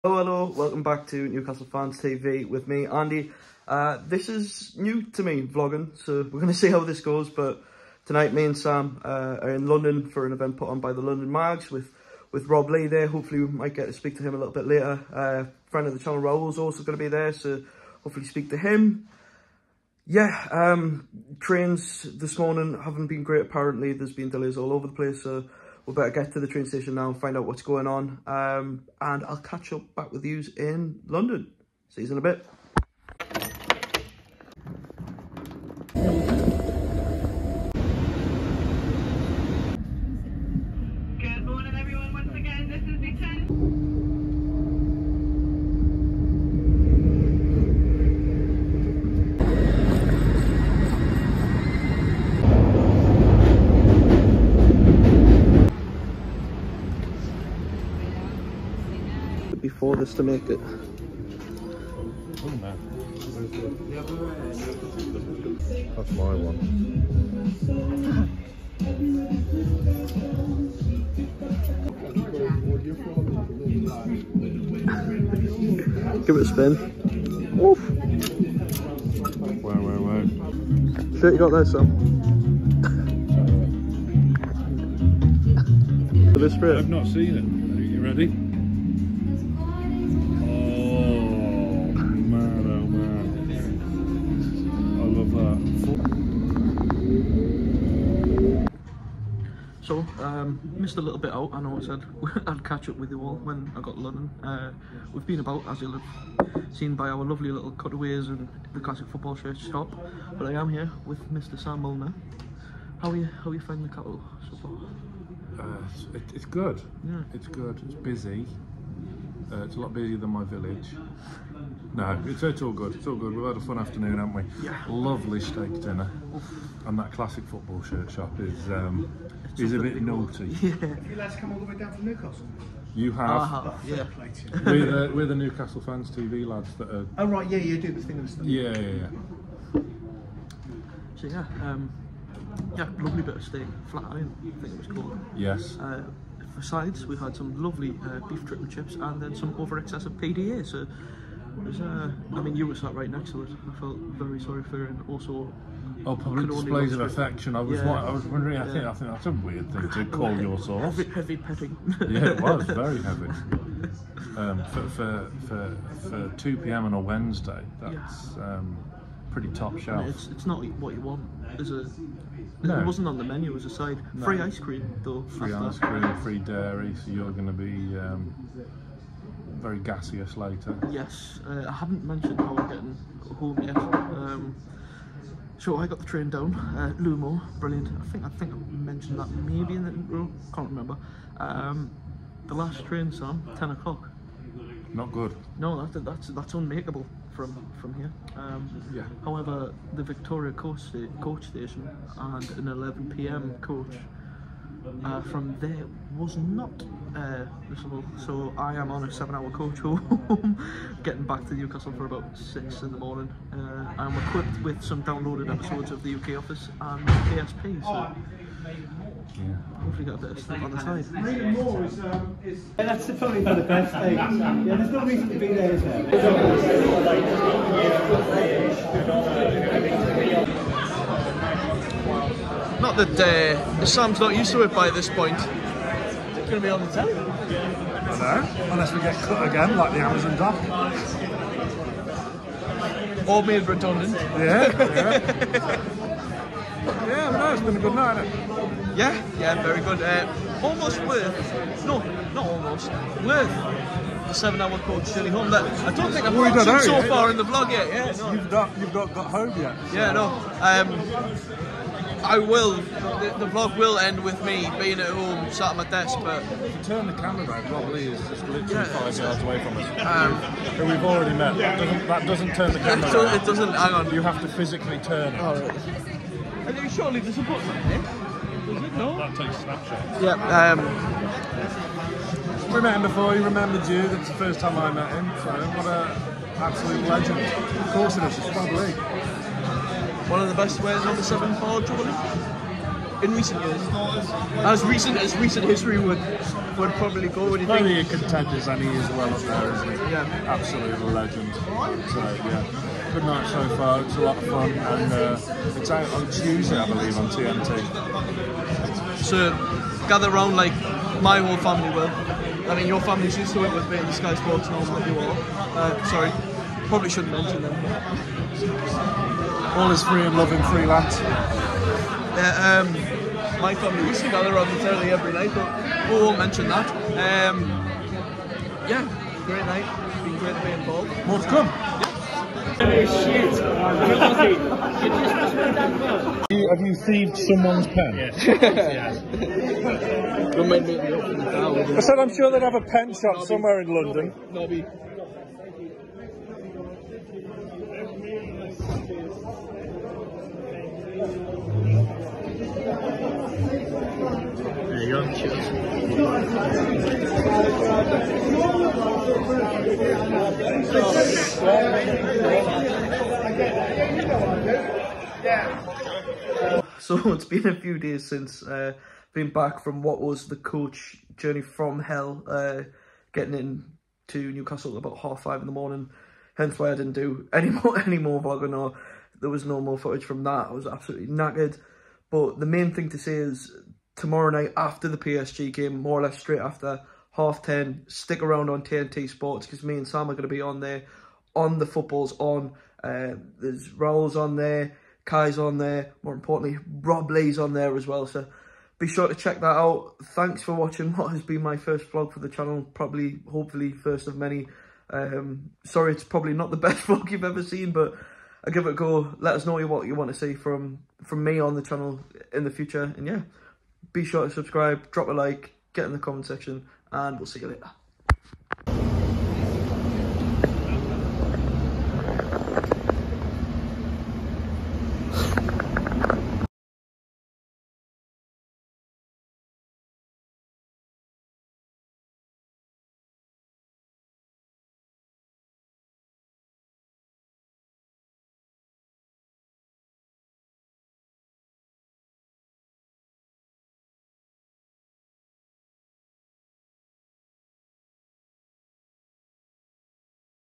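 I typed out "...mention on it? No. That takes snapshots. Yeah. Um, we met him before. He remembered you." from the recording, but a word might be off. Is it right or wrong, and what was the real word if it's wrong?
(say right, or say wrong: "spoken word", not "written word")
wrong: "button", not "mention".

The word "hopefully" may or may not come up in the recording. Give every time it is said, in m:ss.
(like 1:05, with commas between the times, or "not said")
0:13, 0:18, 3:39, 6:43.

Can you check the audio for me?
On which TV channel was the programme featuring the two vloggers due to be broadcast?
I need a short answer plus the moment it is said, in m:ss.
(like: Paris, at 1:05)
TNT Sports, at 6:28.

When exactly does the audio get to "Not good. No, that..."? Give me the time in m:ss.
3:14.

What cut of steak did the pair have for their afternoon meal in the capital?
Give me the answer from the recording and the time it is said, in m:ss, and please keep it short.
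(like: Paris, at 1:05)
Flat iron, at 2:23.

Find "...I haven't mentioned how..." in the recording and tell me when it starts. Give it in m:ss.
3:01.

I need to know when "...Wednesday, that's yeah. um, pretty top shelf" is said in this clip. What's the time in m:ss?
2:46.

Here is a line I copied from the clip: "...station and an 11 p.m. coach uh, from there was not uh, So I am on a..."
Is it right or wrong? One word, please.
right.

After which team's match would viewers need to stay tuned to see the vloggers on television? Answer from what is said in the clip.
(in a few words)
PSG.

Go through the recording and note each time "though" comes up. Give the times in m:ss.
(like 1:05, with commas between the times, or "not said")
2:55.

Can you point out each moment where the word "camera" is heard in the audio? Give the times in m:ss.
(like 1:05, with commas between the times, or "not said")
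4:27, 4:32.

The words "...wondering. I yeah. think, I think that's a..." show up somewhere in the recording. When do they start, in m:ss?
2:38.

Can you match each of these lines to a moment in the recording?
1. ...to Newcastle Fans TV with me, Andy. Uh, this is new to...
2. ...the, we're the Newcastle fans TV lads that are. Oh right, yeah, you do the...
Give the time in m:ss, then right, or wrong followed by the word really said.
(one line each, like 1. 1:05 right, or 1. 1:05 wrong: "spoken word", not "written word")
1. 0:01 right
2. 2:15 right.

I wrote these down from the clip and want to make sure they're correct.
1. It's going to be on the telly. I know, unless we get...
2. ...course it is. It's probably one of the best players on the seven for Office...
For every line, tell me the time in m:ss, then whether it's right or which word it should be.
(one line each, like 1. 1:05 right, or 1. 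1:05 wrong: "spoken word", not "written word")
1. 3:55 right
2. 4:47 wrong: "Jubilee", not "Office".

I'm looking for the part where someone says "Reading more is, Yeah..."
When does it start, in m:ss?
3:41.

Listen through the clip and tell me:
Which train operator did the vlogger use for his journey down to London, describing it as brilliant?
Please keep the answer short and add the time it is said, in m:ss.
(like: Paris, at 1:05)
Lumo, at 3:06.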